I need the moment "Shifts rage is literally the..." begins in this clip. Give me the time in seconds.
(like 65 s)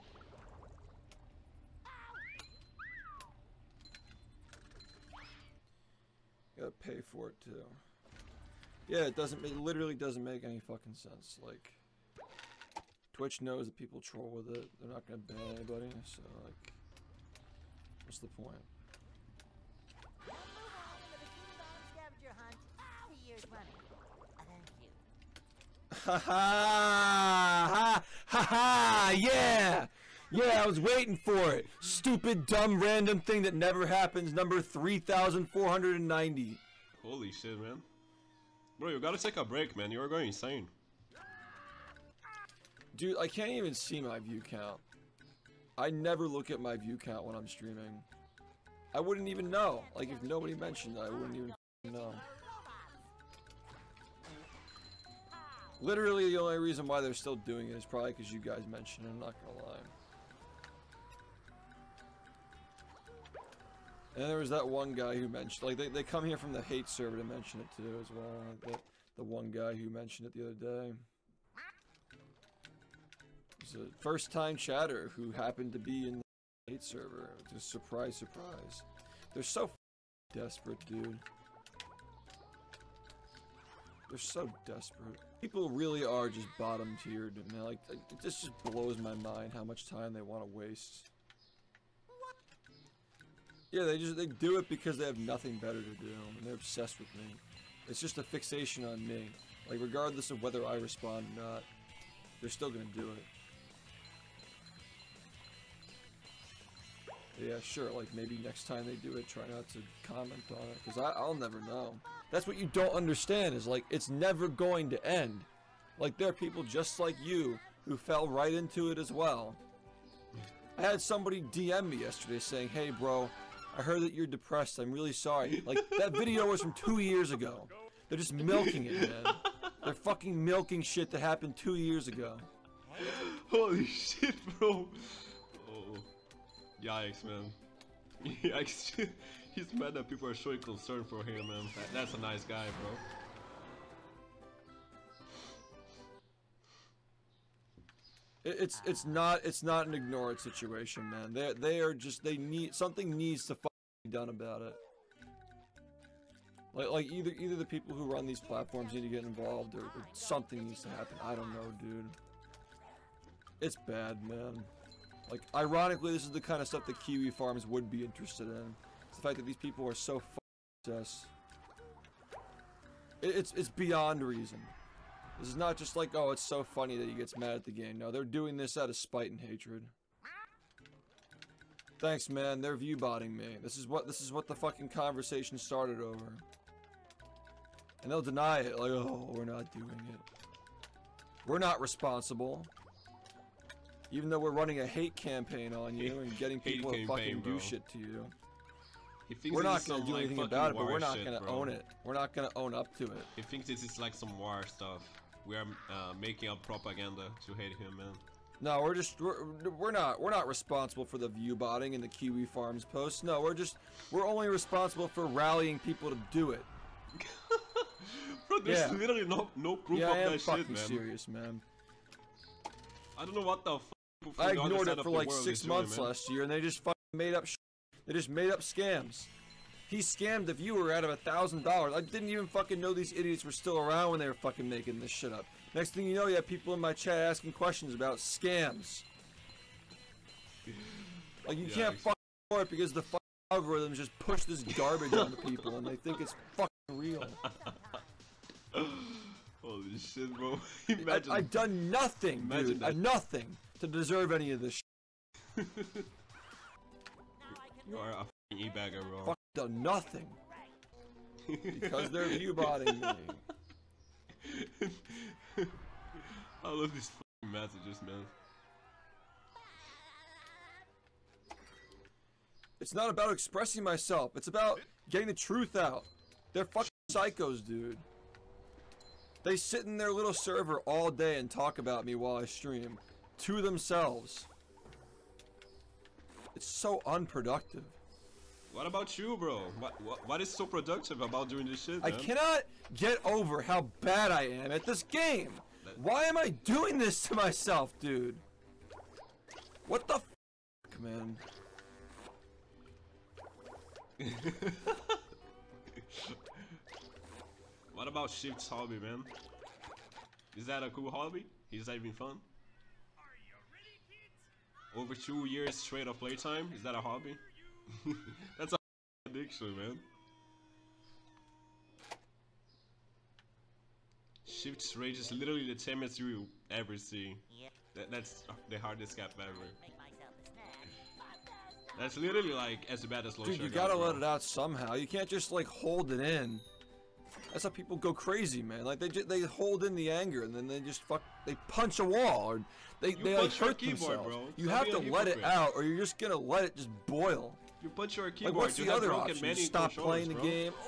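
324 s.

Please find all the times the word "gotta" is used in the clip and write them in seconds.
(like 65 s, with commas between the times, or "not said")
38 s, 333 s.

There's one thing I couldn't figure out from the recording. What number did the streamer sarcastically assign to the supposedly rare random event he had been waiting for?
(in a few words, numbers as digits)
3490.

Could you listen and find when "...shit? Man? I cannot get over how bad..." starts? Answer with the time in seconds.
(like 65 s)
291 s.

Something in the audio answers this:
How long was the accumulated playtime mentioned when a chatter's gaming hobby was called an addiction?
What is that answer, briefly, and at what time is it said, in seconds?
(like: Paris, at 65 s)
over two years, at 314 s.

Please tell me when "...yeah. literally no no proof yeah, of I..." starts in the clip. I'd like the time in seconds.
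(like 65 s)
218 s.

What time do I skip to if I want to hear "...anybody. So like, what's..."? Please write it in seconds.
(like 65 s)
15 s.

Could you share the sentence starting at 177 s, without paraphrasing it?
No, they're doing this out of spite and hatred.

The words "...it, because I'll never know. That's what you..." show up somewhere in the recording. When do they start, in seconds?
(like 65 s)
110 s.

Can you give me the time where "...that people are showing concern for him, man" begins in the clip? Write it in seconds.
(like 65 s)
139 s.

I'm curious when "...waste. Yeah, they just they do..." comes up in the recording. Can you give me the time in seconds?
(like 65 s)
90 s.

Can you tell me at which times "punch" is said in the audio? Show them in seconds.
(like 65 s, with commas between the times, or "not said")
341 s, 347 s.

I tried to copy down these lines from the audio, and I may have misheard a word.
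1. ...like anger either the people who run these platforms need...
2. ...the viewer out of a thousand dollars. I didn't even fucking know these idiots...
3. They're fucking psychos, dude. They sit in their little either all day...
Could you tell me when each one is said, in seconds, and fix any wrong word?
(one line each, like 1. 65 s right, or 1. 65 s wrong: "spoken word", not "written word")
1. 156 s wrong: "either", not "anger"
2. 230 s right
3. 276 s wrong: "server", not "either".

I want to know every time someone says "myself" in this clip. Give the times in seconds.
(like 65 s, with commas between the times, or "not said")
273 s, 297 s.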